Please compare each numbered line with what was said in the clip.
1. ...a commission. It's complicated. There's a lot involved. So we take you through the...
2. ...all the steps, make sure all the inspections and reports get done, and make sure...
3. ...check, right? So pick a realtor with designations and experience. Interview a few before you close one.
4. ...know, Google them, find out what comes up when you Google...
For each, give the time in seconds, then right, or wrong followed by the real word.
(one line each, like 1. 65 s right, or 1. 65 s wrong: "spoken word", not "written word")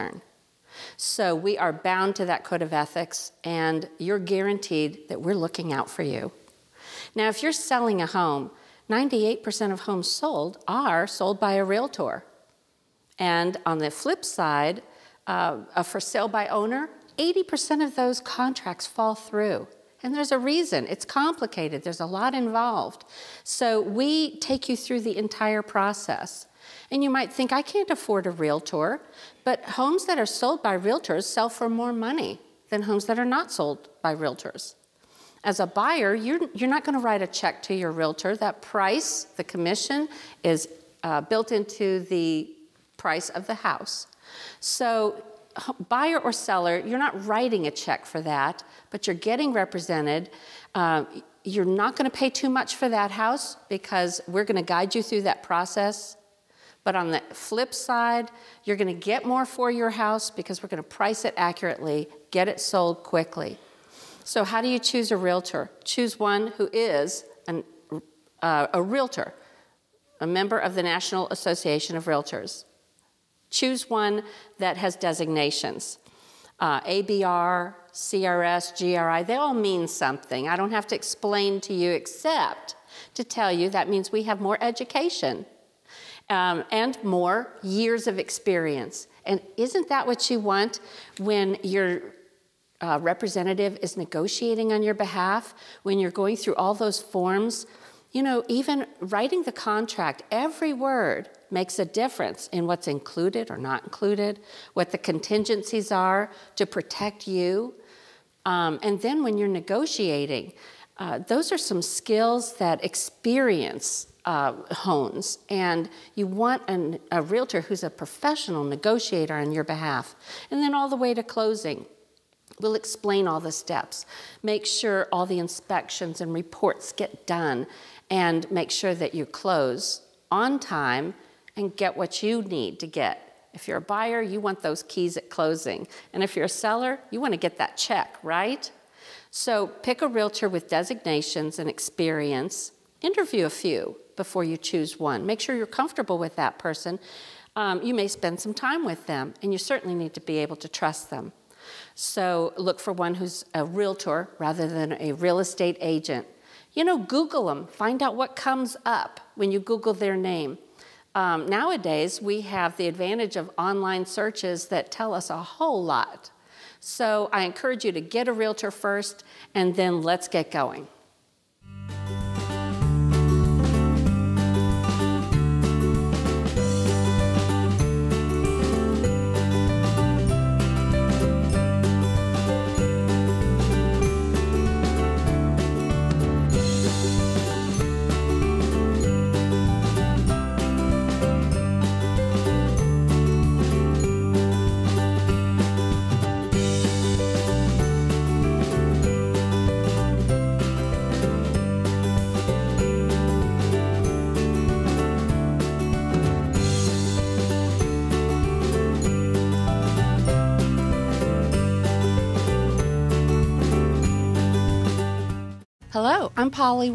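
1. 20 s wrong: "reason", not "commission"
2. 123 s right
3. 137 s wrong: "choose", not "close"
4. 156 s right.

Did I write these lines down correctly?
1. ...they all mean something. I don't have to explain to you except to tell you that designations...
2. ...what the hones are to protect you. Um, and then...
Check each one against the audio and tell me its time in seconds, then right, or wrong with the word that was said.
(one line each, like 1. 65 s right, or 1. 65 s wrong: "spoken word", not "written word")
1. 79 s wrong: "means", not "designations"
2. 104 s wrong: "contingencies", not "hones".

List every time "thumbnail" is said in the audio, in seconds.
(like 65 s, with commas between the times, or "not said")
not said.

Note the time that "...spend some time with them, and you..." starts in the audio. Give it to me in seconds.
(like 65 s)
148 s.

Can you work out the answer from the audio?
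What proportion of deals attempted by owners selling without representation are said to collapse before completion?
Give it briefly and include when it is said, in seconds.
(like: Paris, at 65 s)
80%, at 17 s.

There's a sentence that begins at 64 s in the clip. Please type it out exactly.
So, how do you choose a realtor?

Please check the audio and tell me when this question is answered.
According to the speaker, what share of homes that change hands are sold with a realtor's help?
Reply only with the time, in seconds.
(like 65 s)
8 s.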